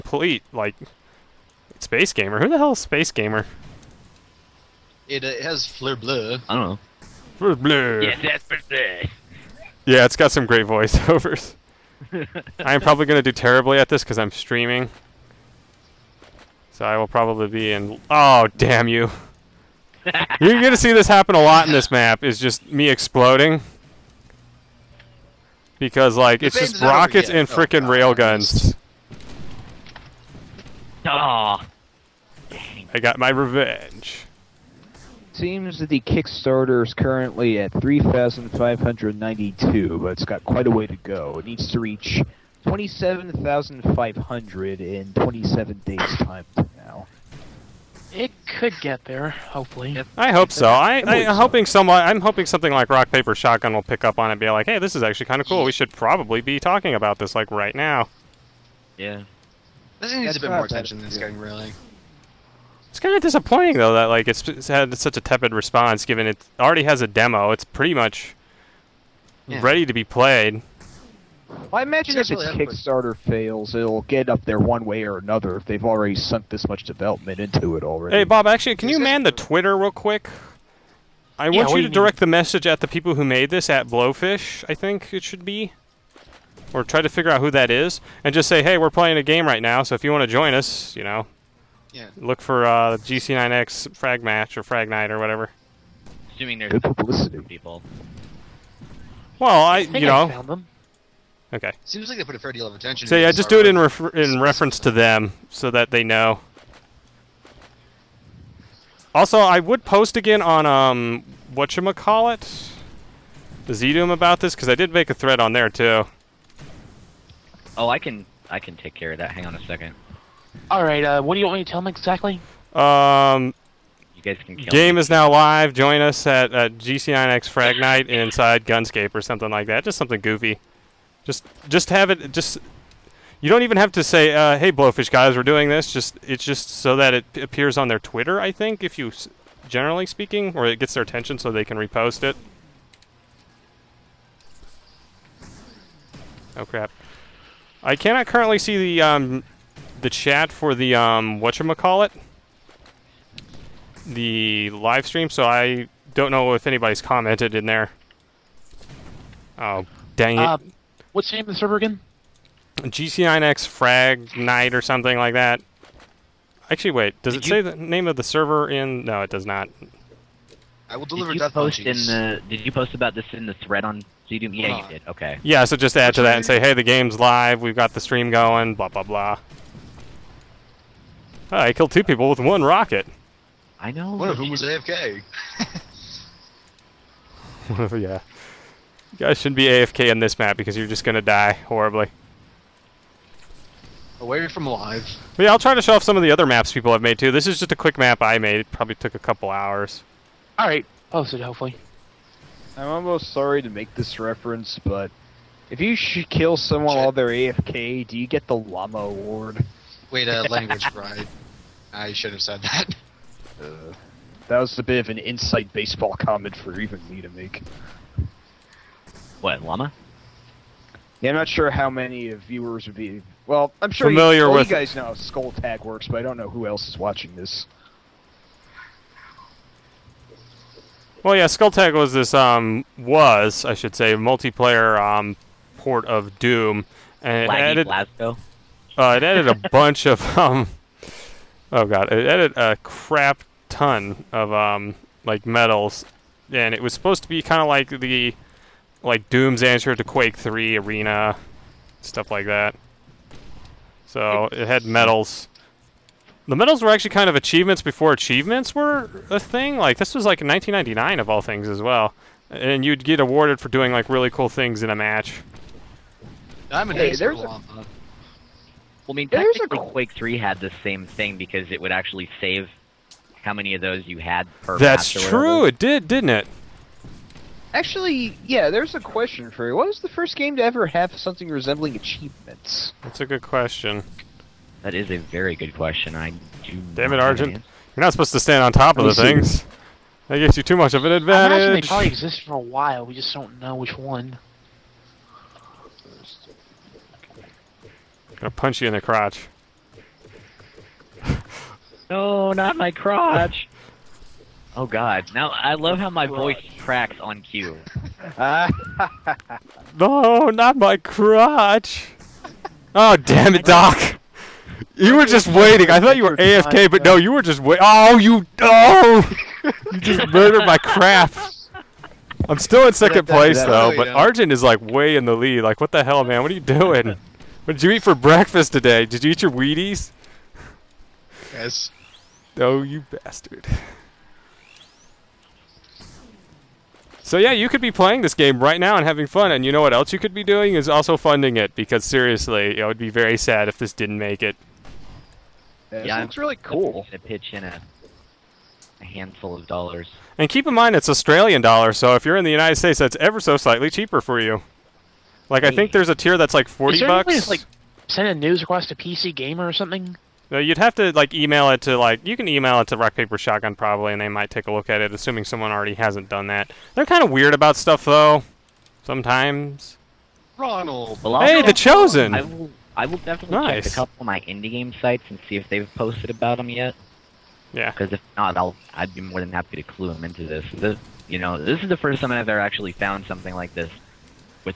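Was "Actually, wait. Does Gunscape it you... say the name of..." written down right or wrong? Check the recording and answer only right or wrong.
wrong.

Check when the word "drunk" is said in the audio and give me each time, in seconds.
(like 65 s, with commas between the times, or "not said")
not said.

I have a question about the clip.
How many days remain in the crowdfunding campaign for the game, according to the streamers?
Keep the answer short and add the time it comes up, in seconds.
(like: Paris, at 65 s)
27, at 45 s.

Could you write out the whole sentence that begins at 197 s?
This is just a quick map I made.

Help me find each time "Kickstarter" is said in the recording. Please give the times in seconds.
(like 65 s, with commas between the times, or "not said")
35 s, 72 s.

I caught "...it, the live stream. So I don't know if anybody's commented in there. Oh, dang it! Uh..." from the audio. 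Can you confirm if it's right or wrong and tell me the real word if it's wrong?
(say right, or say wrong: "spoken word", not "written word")
right.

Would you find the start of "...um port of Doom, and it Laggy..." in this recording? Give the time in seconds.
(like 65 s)
234 s.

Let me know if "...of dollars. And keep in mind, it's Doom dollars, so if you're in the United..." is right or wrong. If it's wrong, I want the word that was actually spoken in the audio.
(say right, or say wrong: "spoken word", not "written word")
wrong: "Australian", not "Doom".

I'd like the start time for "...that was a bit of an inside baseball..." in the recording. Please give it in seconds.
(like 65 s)
214 s.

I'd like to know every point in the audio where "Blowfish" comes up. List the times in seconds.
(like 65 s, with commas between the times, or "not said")
83 s, 134 s.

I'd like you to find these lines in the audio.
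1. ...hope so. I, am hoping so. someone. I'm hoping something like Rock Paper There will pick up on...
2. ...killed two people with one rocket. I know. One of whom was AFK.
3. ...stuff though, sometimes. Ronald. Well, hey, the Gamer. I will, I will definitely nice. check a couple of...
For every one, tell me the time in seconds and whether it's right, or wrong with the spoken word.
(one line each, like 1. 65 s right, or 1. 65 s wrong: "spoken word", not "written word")
1. 50 s wrong: "Shotgun", not "There"
2. 181 s right
3. 367 s wrong: "Chosen", not "Gamer".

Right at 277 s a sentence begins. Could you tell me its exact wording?
Actually, yeah, there's a question for you.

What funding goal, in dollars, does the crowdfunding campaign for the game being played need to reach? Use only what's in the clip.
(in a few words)
27,500.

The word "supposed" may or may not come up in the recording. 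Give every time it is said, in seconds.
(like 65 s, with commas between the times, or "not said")
246 s, 288 s.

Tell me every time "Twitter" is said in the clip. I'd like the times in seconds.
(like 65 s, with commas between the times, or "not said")
79 s, 137 s.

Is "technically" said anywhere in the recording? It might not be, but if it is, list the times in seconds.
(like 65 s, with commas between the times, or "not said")
269 s.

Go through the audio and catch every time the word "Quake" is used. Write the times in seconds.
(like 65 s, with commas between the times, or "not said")
250 s, 269 s.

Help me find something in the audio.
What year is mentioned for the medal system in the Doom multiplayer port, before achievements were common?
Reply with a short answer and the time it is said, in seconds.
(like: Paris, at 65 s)
1999, at 260 s.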